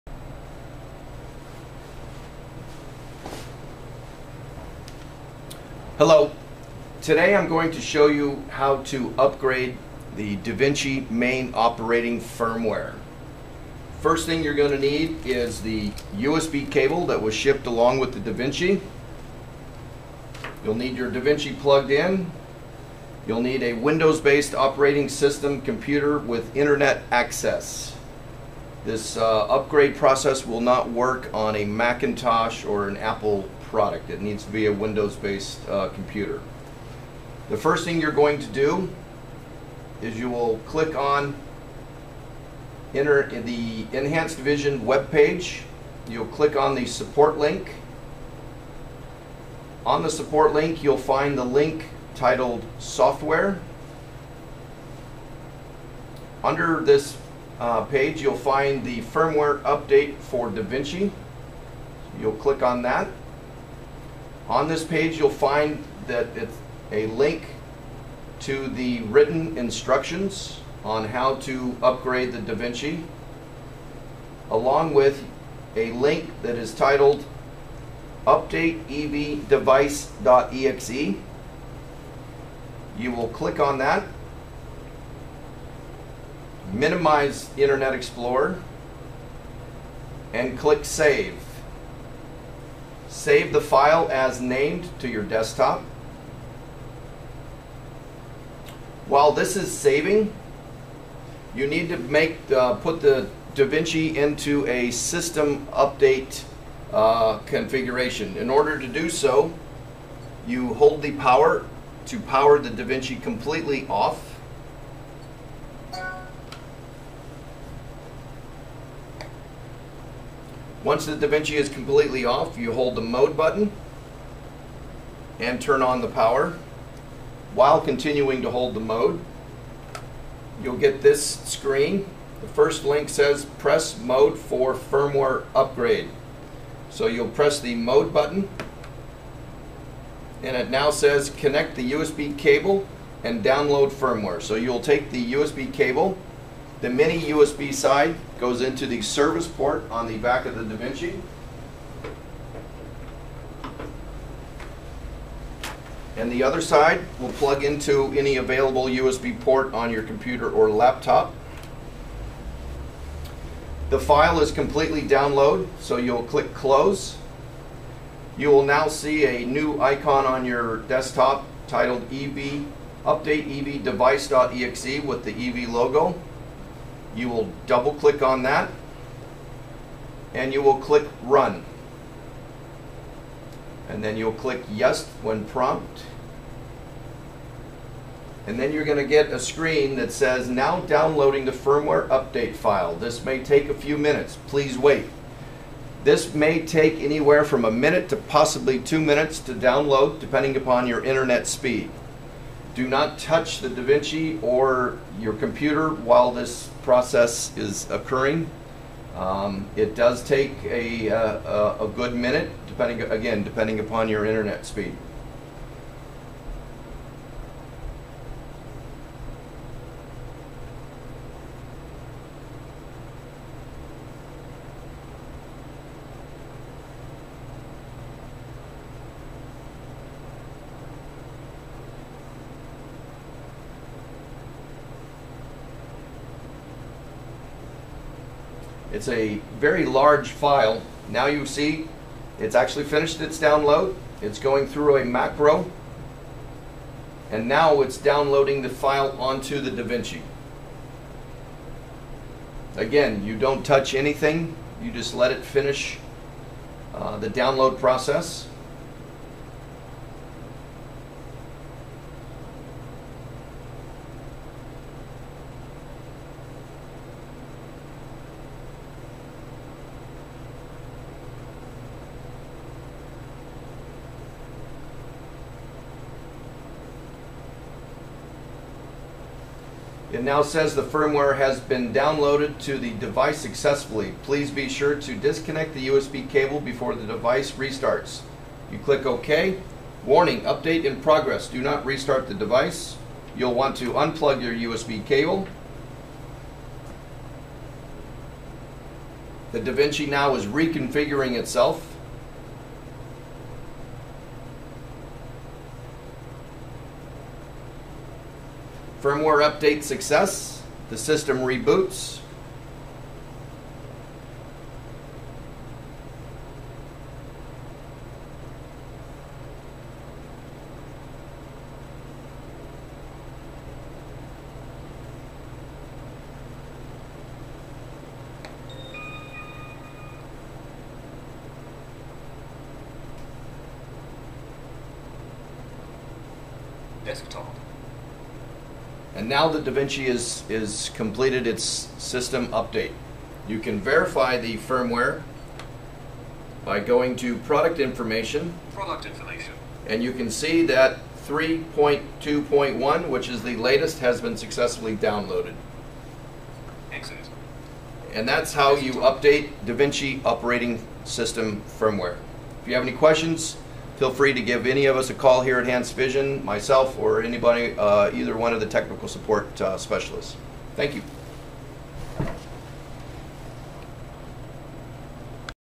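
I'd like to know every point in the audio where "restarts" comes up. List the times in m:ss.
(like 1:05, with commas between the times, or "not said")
4:47, 4:51.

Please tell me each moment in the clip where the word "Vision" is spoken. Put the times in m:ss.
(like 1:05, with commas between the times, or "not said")
0:44, 6:05.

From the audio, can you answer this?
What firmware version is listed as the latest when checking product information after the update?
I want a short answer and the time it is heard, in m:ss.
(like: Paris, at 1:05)
3.2.1, at 5:51.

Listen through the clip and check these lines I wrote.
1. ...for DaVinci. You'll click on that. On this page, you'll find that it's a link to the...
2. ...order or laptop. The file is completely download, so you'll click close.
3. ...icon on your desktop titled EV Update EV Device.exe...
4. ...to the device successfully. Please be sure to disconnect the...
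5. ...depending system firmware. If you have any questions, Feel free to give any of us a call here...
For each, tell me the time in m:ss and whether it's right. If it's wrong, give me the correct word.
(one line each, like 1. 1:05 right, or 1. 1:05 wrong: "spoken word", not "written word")
1. 1:00 right
2. 2:40 wrong: "computer", not "order"
3. 2:49 right
4. 4:42 right
5. 6:00 wrong: "operating", not "depending".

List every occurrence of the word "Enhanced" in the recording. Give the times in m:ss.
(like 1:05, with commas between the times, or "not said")
0:43, 6:05.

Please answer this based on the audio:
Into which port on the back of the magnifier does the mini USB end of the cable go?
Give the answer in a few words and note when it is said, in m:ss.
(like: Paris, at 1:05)
Service port, at 2:29.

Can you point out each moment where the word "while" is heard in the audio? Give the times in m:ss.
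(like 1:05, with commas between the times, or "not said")
1:39, 2:07, 3:25.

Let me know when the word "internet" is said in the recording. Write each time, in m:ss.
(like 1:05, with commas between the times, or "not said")
0:26, 1:27, 3:21, 3:34.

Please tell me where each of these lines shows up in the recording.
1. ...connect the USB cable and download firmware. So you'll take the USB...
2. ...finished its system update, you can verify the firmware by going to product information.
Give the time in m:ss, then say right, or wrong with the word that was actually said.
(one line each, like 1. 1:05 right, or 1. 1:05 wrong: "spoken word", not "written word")
1. 2:21 right
2. 5:40 wrong: "completed", not "finished".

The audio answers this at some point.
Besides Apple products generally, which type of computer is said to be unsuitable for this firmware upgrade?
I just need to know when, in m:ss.
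0:31.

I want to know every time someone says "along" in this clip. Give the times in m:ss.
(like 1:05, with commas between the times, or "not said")
0:17, 1:14.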